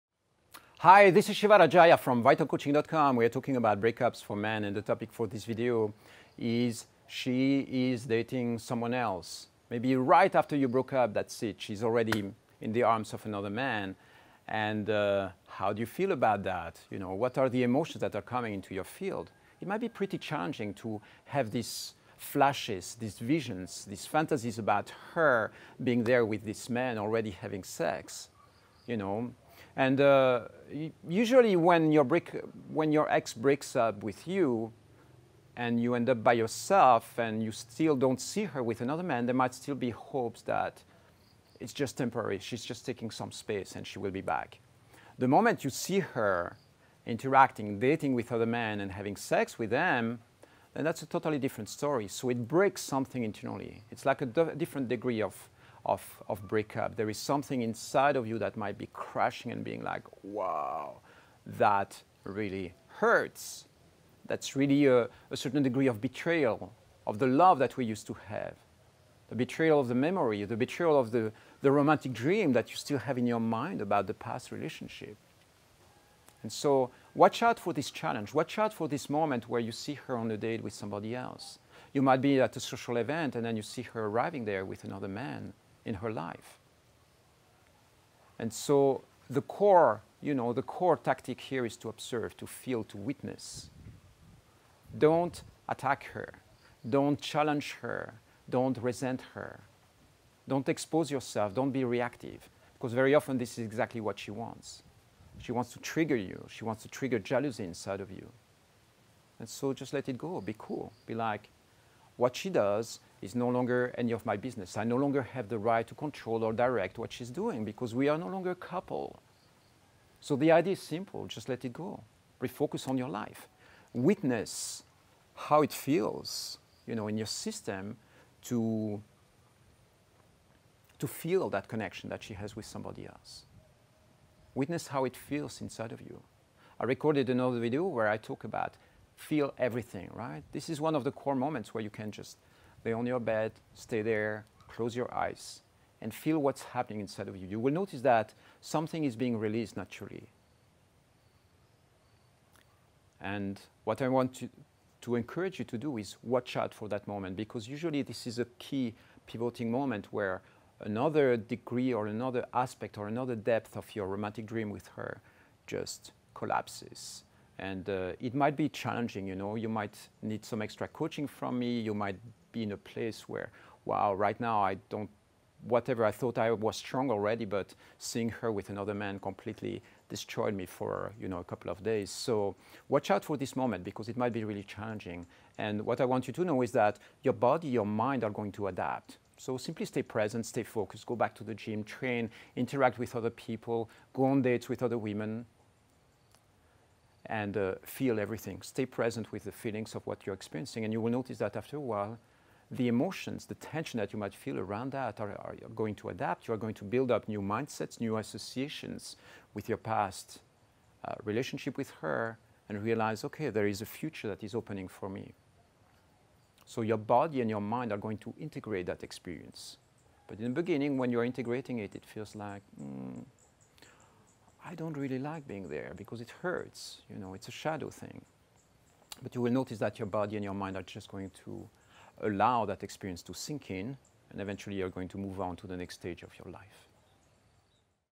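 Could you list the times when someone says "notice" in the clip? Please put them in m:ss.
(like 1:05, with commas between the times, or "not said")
2:27, 3:21, 3:49.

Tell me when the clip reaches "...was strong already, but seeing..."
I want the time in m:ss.
2:56.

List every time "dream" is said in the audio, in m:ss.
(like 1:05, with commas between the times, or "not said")
1:12, 2:44.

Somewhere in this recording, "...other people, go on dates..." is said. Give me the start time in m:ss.
3:13.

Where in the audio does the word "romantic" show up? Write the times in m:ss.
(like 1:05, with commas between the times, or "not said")
1:11, 2:44.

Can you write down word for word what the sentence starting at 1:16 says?
And so, watch out for this challenge.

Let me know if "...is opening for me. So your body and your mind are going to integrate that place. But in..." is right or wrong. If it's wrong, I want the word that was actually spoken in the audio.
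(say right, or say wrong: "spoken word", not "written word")
wrong: "experience", not "place".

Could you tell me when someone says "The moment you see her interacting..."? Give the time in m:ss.
0:45.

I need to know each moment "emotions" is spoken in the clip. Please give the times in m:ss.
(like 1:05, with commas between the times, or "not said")
0:17, 3:22.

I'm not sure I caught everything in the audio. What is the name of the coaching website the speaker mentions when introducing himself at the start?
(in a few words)
vitalcoaching.com.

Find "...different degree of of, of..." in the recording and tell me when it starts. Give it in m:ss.
0:54.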